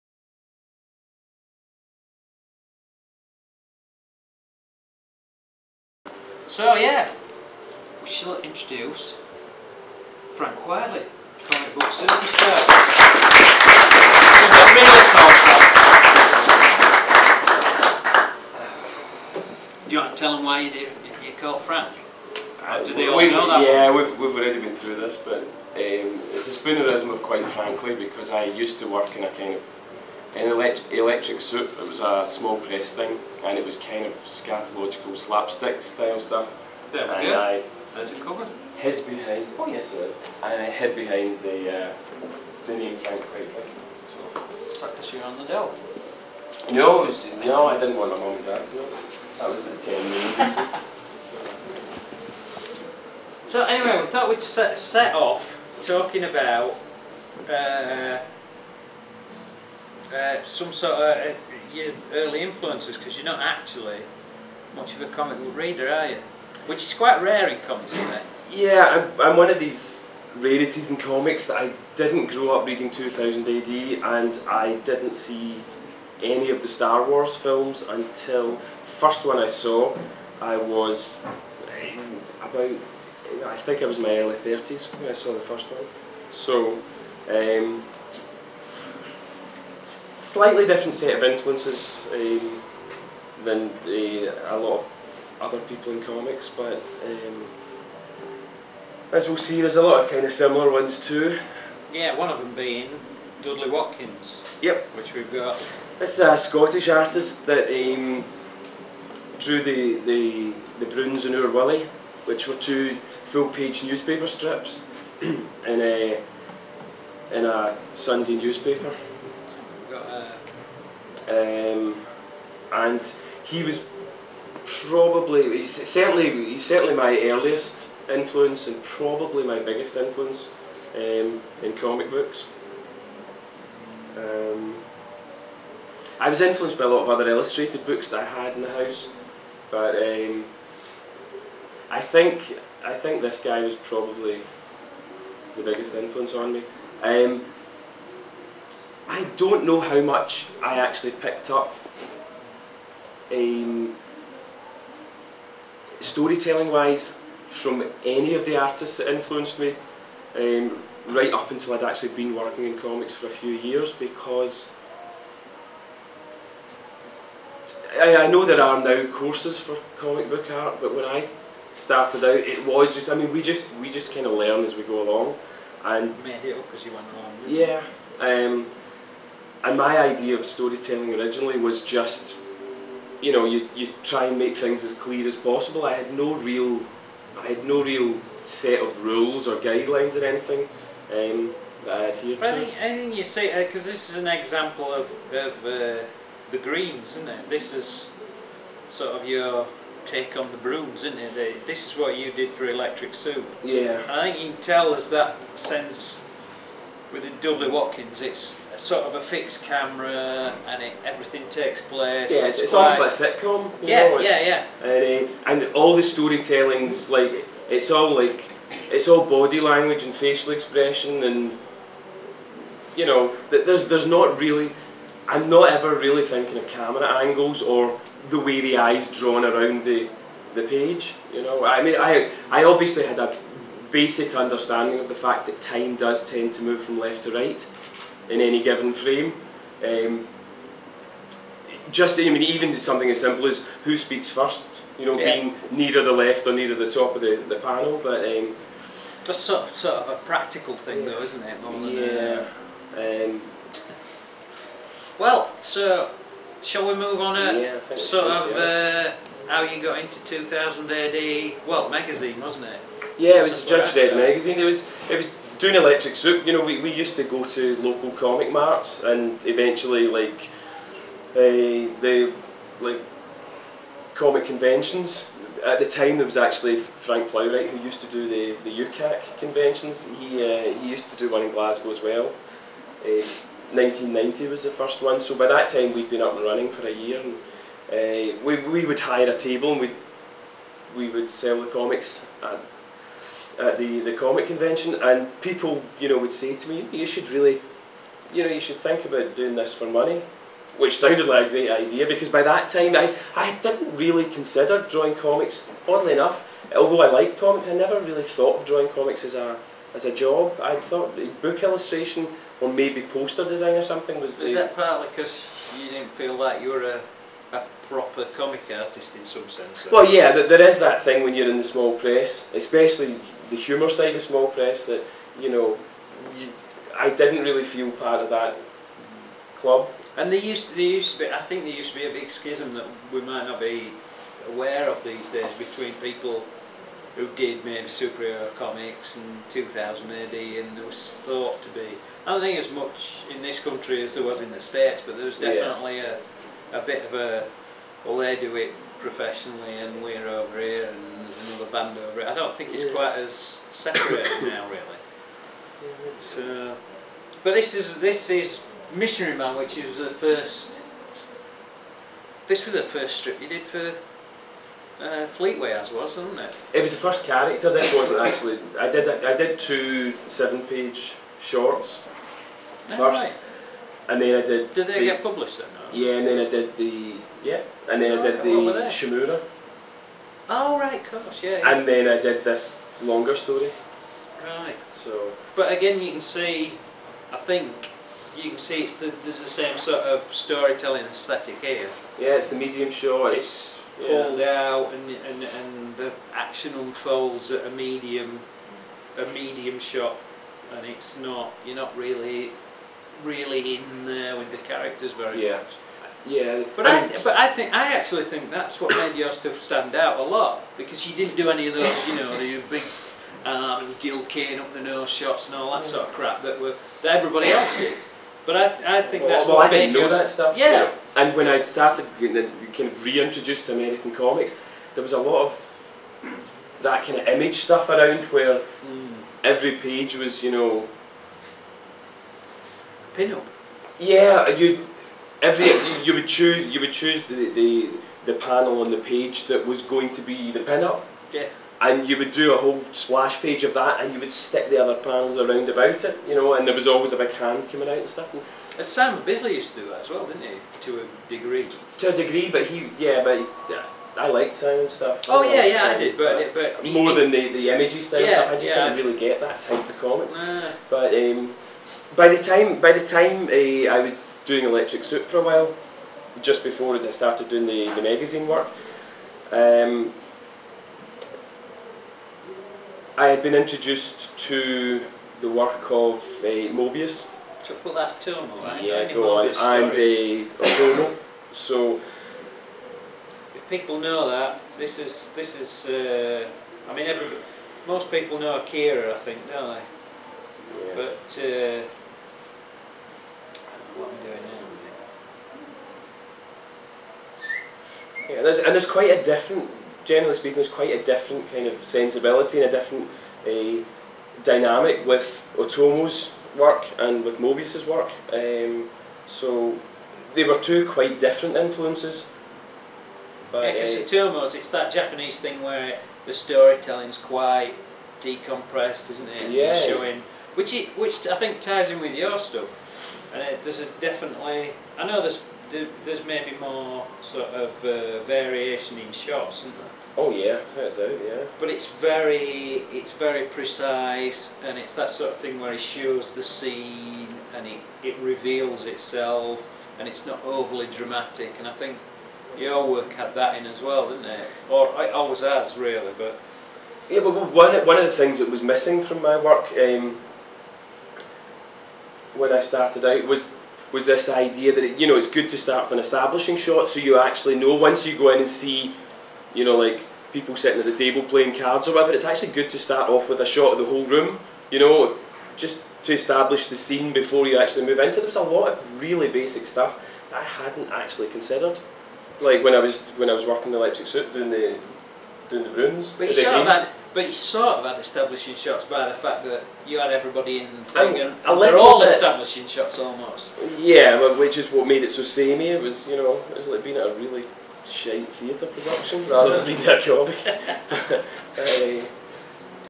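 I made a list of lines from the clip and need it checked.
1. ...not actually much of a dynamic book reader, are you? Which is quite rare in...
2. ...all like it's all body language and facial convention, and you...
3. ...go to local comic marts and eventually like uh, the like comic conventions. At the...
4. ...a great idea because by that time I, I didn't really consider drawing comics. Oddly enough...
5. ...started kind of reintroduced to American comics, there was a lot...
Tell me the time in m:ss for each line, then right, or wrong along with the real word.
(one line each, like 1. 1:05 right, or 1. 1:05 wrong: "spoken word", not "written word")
1. 1:03 wrong: "comic", not "dynamic"
2. 3:37 wrong: "expression", not "convention"
3. 4:27 right
4. 5:01 right
5. 7:01 right.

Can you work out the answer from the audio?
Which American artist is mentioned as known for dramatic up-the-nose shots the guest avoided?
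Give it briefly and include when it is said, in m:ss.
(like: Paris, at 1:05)
Gil Kane, at 6:53.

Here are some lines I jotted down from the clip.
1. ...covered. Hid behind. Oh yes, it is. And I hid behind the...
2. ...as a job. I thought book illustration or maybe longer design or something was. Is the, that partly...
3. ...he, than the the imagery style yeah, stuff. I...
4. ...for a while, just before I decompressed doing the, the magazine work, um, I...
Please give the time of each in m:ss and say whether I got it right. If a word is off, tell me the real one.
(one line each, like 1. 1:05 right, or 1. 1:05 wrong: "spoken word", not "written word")
1. 0:38 right
2. 5:09 wrong: "poster", not "longer"
3. 7:37 right
4. 7:45 wrong: "started", not "decompressed".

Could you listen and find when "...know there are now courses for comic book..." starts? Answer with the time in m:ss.
2:48.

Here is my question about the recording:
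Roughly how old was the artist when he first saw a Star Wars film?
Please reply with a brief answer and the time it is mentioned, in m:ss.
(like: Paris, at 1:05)
early 30s, at 1:24.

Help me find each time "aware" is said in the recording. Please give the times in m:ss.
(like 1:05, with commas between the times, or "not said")
5:34.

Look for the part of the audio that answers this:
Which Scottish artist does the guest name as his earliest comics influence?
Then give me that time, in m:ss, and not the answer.
1:43.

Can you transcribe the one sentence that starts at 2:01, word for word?
Um, and he was probably, he's certainly, he's certainly my earliest influence and probably my biggest influence um, in comic books.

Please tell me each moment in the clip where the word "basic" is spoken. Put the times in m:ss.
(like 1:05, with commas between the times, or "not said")
3:53, 9:29.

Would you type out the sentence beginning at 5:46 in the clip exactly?
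a a bit of a well they do it professionally and we're over here and there's another band over it.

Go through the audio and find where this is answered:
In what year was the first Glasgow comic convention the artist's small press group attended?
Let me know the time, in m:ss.
4:43.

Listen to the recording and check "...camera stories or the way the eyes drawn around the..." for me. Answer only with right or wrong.
wrong.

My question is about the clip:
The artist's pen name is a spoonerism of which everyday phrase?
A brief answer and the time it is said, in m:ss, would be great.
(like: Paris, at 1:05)
quite frankly, at 0:27.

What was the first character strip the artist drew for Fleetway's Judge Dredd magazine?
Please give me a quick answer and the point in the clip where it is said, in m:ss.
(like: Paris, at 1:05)
Missionary Man, at 5:58.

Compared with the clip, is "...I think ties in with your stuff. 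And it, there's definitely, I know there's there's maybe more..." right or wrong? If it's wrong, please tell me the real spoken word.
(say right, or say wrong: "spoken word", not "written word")
right.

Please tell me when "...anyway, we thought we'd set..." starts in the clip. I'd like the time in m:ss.
0:53.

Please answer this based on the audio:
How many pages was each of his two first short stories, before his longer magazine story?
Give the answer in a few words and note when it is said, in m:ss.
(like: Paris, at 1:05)
7, at 6:10.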